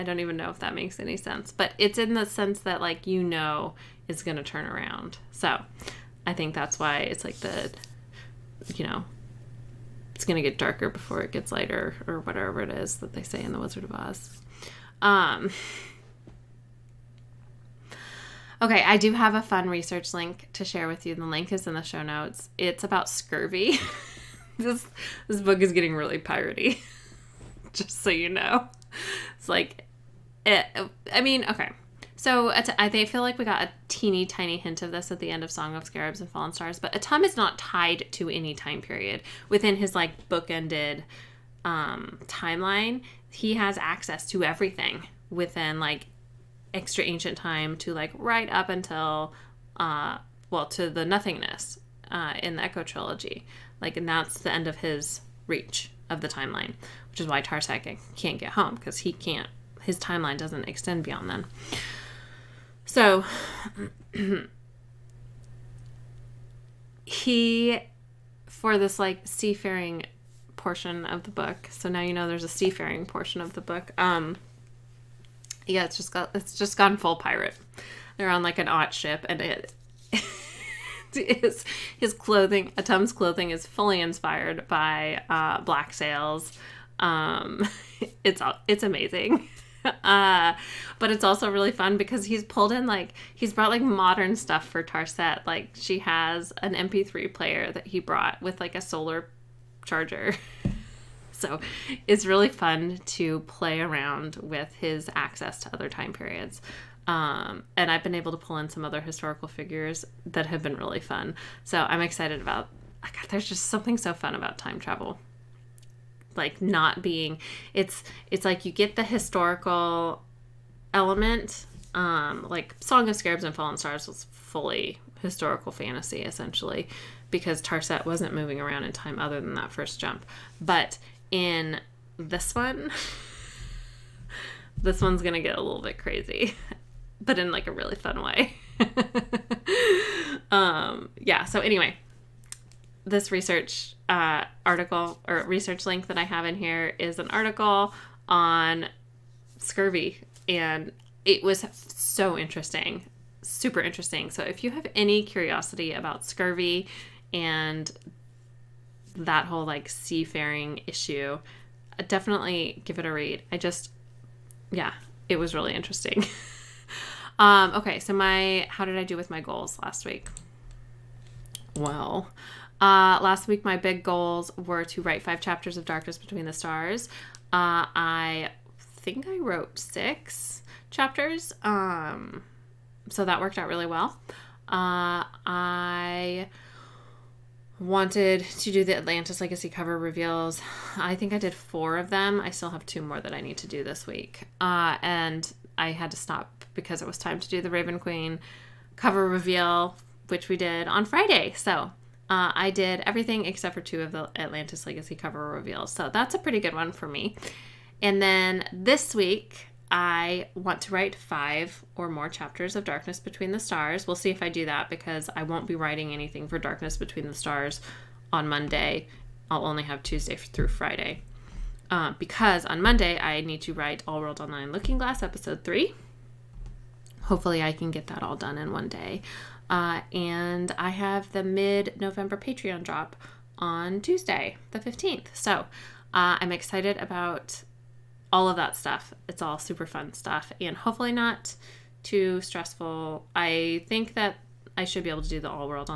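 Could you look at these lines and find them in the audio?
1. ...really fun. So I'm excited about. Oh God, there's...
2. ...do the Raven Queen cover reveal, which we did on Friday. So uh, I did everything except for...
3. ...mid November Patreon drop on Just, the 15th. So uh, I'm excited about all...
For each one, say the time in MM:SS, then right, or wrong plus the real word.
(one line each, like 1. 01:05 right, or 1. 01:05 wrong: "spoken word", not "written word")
1. 01:50 right
2. 03:17 right
3. 03:51 wrong: "Tuesday", not "Just".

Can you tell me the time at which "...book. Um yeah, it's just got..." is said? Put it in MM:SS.
01:13.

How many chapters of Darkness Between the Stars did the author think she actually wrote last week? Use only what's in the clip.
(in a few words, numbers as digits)
6.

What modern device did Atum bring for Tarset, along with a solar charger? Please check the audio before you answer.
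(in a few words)
MP3 player.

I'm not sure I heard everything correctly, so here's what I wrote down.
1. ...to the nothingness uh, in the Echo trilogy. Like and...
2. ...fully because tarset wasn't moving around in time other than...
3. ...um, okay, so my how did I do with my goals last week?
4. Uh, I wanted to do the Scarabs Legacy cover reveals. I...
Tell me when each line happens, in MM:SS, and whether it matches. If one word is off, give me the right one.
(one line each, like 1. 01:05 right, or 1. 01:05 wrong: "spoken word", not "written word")
1. 00:50 right
2. 02:06 wrong: "essentially", not "fully"
3. 02:47 right
4. 03:04 wrong: "Atlantis", not "Scarabs".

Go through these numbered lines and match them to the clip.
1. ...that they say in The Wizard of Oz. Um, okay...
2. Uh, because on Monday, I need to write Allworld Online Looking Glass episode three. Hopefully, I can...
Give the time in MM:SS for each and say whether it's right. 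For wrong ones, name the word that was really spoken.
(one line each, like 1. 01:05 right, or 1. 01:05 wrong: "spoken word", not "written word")
1. 00:12 right
2. 03:41 right.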